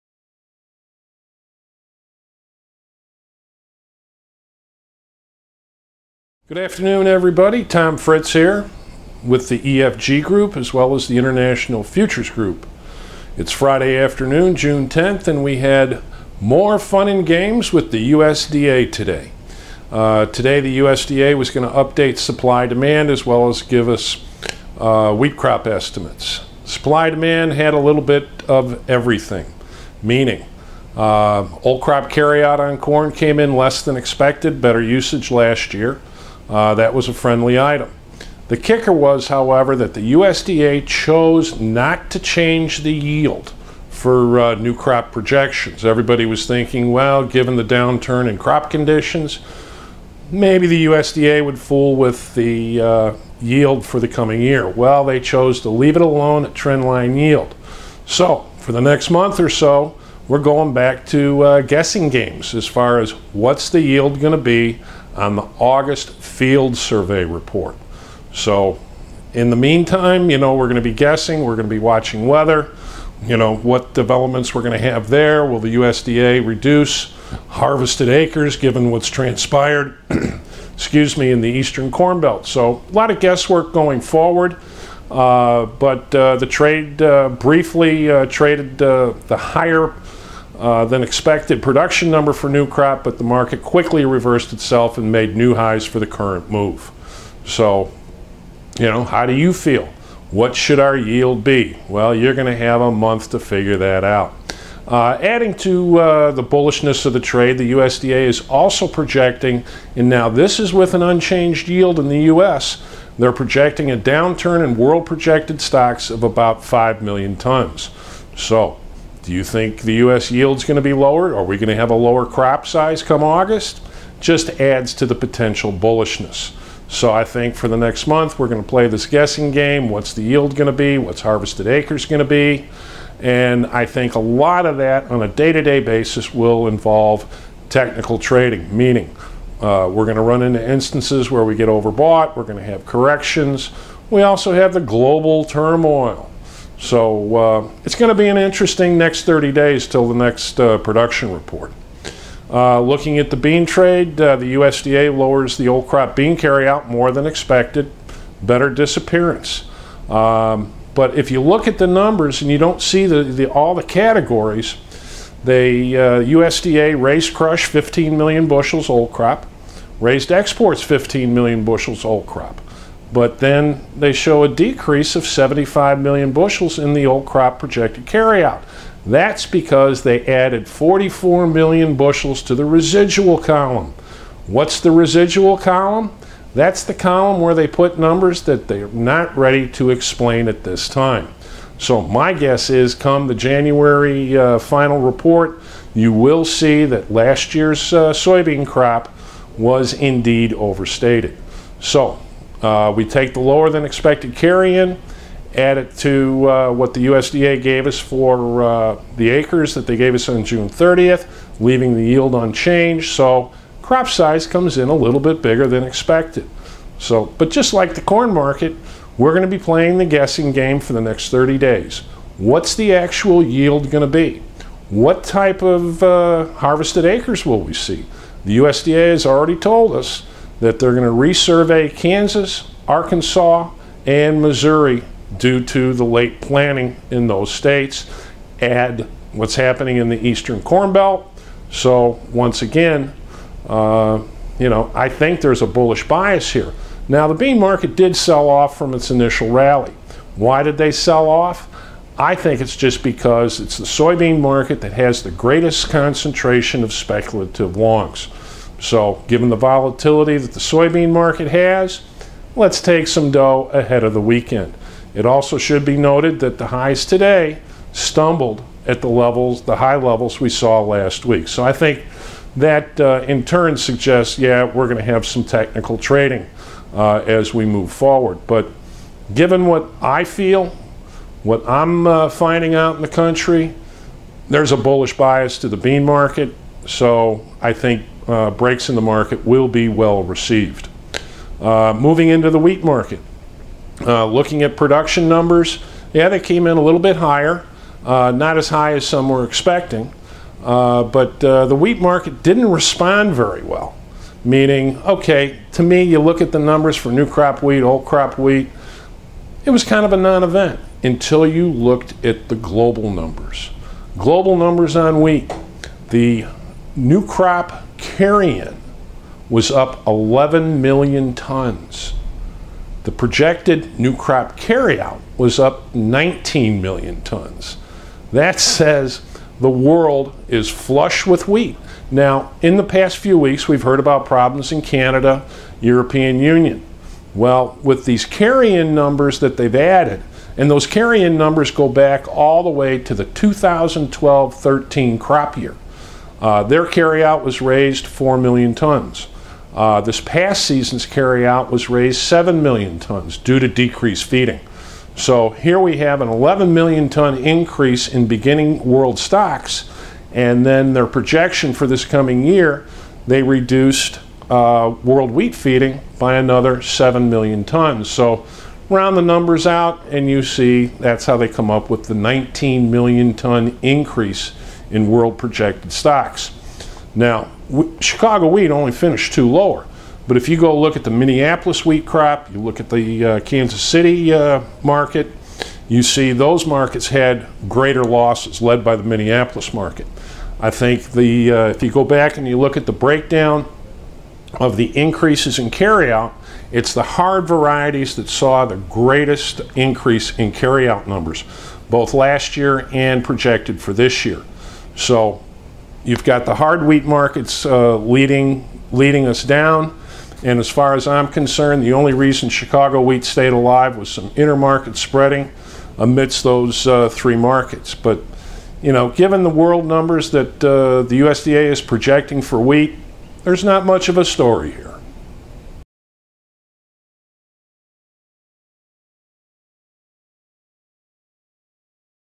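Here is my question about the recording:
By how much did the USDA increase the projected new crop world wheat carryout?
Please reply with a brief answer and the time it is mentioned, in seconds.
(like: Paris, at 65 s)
19 million tons, at 325 s.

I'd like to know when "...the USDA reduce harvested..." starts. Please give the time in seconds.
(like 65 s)
75 s.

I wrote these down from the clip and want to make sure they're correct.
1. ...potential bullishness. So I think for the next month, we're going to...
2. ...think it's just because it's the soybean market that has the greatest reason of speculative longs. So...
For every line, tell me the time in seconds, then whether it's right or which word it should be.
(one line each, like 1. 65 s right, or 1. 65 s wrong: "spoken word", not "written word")
1. 125 s right
2. 252 s wrong: "concentration", not "reason".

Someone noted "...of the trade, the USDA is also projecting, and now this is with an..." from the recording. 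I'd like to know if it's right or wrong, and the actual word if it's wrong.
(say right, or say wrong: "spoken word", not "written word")
right.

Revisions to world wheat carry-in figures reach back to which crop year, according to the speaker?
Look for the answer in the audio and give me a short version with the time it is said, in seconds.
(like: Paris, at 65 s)
2012-13, at 343 s.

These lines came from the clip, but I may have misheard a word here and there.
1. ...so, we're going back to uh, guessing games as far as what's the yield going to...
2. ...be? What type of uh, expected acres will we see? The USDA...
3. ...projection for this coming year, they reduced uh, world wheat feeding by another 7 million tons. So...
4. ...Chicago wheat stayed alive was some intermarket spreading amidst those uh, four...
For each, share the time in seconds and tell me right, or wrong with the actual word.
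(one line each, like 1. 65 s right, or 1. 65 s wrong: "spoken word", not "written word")
1. 59 s right
2. 224 s wrong: "harvested", not "expected"
3. 361 s right
4. 412 s wrong: "three", not "four".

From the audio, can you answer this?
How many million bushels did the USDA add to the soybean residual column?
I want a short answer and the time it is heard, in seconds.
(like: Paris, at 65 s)
44 million bushels, at 180 s.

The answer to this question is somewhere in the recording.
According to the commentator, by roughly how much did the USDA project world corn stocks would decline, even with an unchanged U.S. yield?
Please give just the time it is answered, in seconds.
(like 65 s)
116 s.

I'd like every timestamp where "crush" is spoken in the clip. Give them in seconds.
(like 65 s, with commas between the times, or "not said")
167 s.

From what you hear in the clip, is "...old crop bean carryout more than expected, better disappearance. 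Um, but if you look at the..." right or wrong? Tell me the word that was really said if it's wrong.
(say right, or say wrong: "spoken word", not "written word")
right.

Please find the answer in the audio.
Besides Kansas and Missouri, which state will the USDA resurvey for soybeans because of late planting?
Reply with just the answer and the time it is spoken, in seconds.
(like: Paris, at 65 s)
Arkansas, at 232 s.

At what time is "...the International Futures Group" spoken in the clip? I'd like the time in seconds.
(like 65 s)
11 s.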